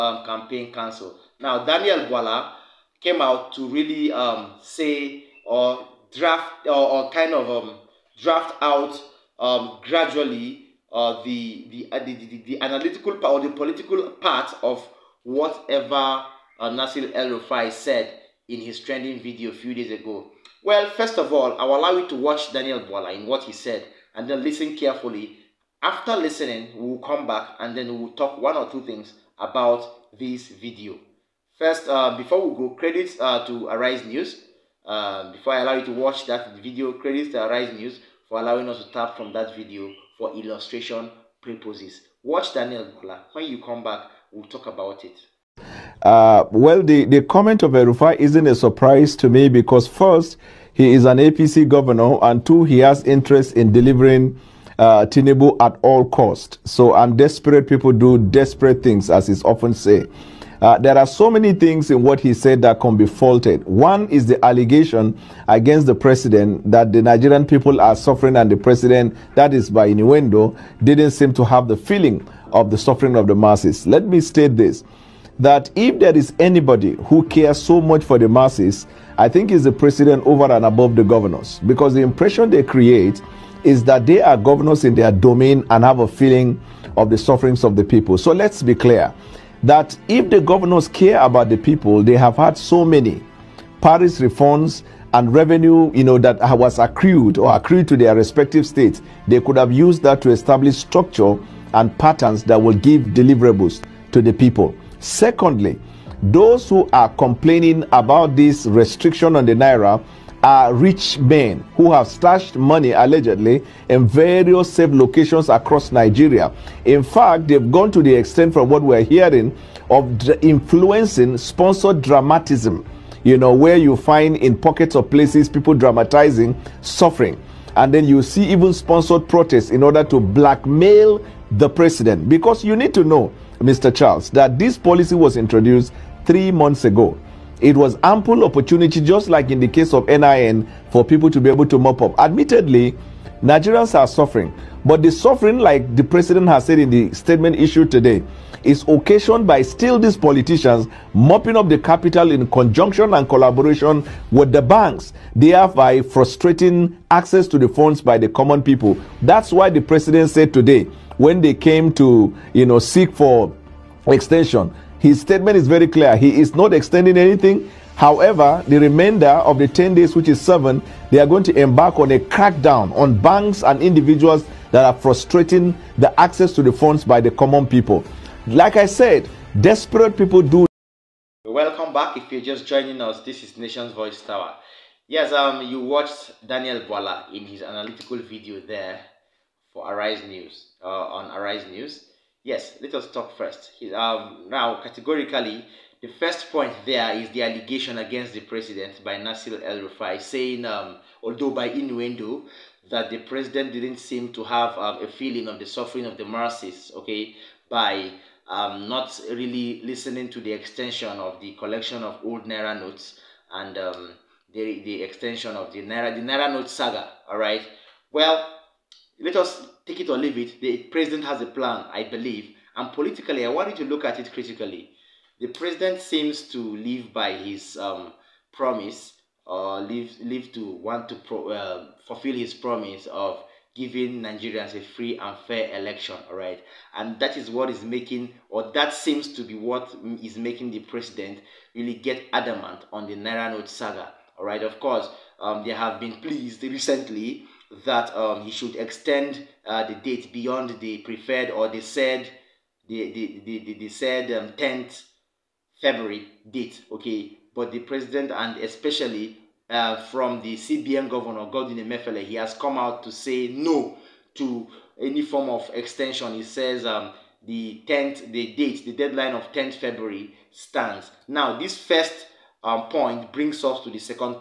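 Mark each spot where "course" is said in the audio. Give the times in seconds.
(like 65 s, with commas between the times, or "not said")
244 s.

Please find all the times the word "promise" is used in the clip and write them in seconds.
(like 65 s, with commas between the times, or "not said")
228 s, 232 s.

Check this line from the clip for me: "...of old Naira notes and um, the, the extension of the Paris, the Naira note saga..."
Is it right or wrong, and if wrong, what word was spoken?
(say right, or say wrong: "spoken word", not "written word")
wrong: "Naira", not "Paris".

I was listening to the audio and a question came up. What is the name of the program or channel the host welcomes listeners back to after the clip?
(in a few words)
Nation's Voice Tower.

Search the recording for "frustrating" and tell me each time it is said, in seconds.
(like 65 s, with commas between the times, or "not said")
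155 s, 174 s.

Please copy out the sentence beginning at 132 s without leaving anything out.
Because you need to know, Mr.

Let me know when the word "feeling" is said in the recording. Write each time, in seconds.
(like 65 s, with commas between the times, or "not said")
71 s, 86 s, 205 s.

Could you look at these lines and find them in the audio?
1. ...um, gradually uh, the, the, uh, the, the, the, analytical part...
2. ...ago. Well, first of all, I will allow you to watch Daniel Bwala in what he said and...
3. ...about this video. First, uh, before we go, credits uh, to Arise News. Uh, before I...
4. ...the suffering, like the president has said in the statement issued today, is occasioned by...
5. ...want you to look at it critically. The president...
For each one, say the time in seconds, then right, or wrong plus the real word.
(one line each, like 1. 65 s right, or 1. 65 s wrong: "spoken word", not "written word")
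1. 9 s right
2. 19 s right
3. 29 s right
4. 145 s right
5. 223 s right.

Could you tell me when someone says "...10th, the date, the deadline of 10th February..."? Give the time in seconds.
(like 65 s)
267 s.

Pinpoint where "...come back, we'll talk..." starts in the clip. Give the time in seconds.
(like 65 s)
43 s.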